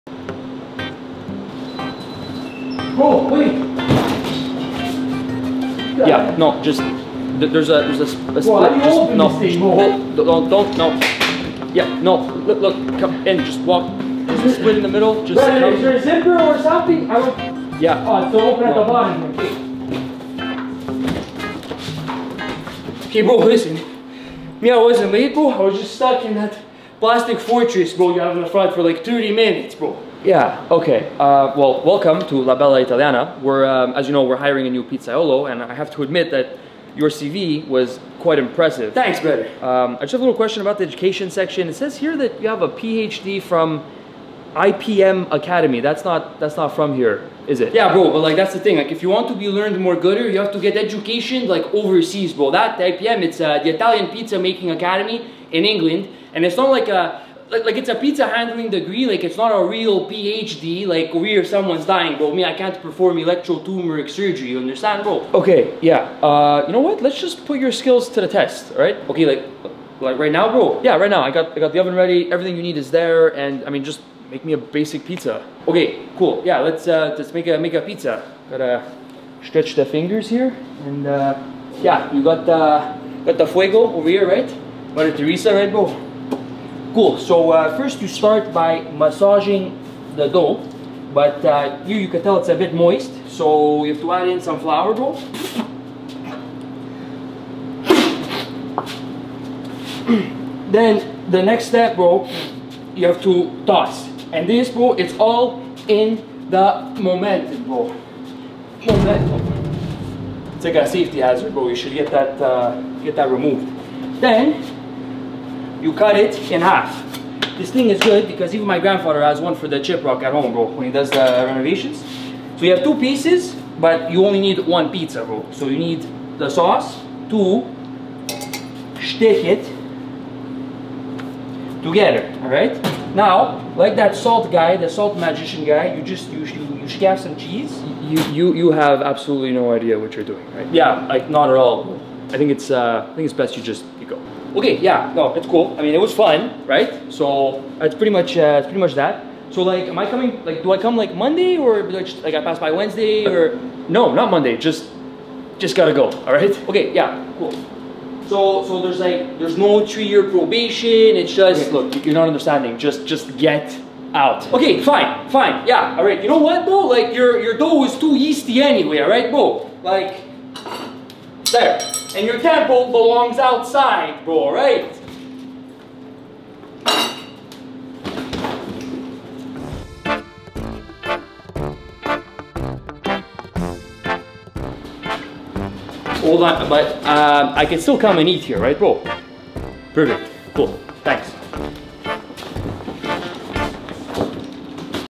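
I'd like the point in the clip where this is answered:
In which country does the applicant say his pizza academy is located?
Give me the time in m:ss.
0:55.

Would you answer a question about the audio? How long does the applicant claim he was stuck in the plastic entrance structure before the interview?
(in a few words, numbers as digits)
30 minutes.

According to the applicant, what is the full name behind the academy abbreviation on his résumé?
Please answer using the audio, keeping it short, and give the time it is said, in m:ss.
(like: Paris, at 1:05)
Italian Pizza Making Academy, at 0:53.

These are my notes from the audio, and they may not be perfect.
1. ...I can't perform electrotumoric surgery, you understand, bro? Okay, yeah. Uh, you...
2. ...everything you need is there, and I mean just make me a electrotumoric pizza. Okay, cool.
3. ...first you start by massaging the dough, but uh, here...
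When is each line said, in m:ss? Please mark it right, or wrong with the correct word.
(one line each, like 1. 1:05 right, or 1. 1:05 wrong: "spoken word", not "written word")
1. 1:02 right
2. 1:12 wrong: "basic", not "electrotumoric"
3. 1:27 right.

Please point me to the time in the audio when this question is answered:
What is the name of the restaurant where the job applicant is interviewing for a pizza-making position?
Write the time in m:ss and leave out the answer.
0:32.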